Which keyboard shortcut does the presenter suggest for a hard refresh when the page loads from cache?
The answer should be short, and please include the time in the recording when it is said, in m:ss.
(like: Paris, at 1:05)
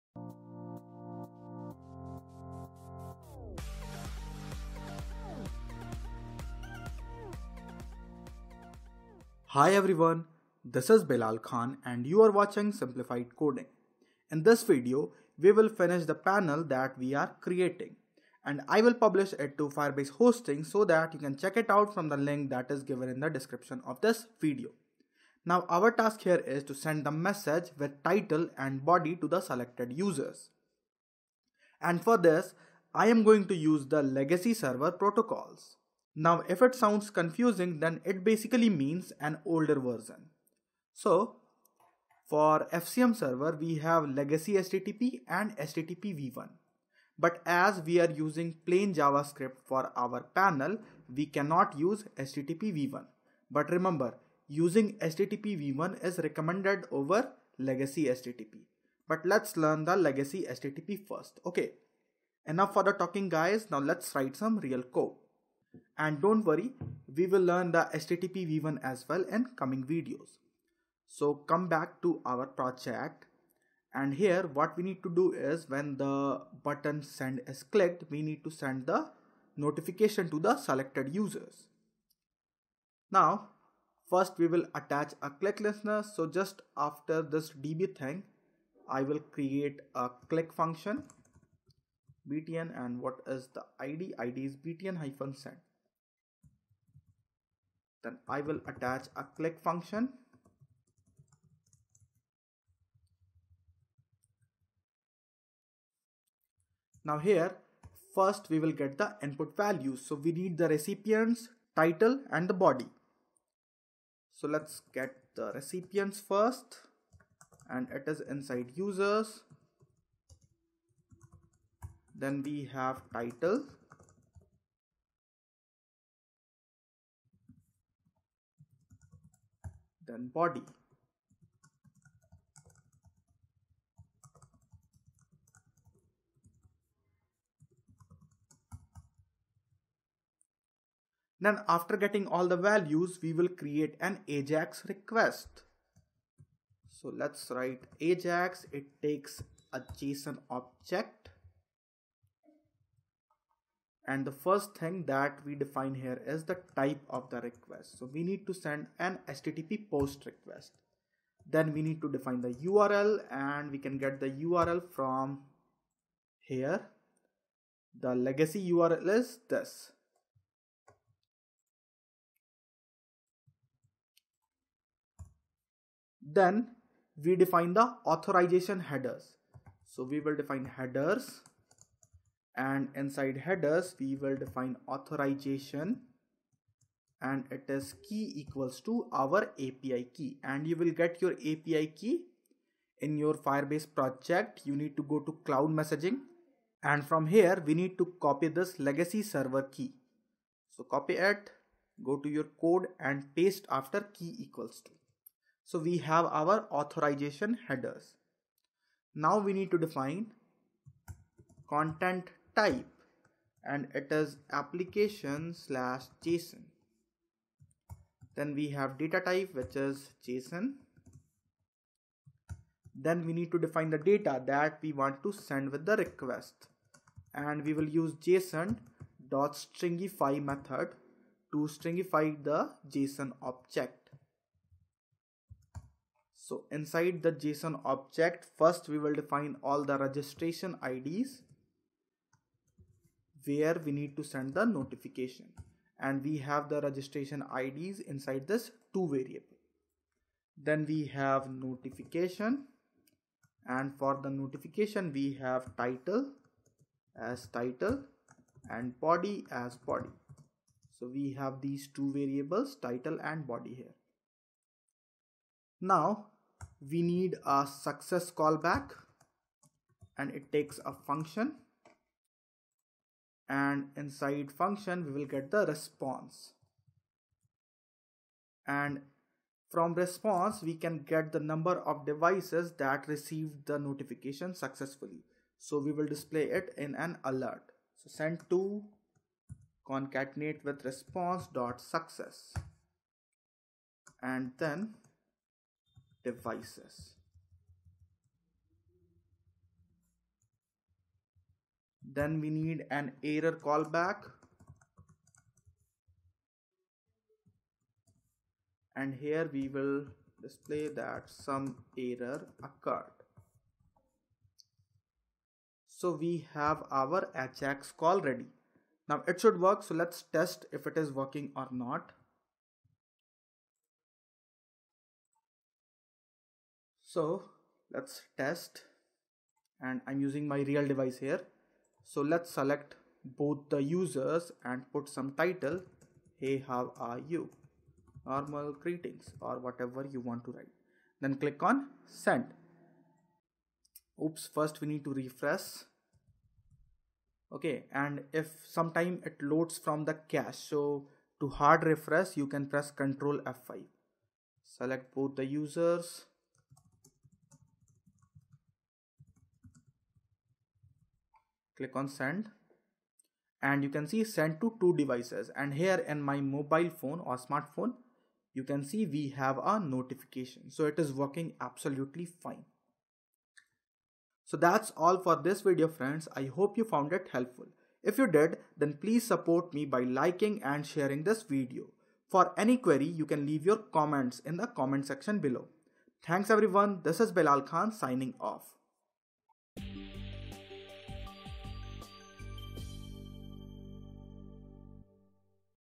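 Ctrl F5, at 5:53.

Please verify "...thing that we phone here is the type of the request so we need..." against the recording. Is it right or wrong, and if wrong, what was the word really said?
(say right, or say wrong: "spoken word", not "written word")
wrong: "define", not "phone".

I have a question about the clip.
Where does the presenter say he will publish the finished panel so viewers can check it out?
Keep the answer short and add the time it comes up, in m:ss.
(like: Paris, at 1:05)
Firebase hosting, at 0:19.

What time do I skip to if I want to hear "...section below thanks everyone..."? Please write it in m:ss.
6:25.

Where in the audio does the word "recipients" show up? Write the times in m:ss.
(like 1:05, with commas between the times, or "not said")
1:50, 1:55.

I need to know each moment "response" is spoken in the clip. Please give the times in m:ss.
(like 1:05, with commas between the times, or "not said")
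4:35, 4:39, 4:50.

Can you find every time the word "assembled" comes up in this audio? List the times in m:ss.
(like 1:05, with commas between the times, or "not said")
not said.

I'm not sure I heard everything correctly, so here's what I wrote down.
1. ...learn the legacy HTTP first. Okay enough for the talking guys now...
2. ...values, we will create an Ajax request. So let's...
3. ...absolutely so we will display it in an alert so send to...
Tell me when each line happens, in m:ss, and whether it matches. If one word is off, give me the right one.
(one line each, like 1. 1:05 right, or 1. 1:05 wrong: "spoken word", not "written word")
1. 0:59 right
2. 2:22 right
3. 4:44 wrong: "successfully", not "absolutely".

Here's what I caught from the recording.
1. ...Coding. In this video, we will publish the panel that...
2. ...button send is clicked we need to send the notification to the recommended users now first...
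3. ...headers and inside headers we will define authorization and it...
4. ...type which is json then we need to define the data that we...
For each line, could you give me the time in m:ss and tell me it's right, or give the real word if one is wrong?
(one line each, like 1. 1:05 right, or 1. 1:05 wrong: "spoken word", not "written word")
1. 0:13 wrong: "finish", not "publish"
2. 1:16 wrong: "selected", not "recommended"
3. 3:00 right
4. 3:39 right.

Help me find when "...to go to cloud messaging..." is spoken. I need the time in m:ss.
3:14.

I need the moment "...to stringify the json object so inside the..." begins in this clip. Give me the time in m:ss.
3:51.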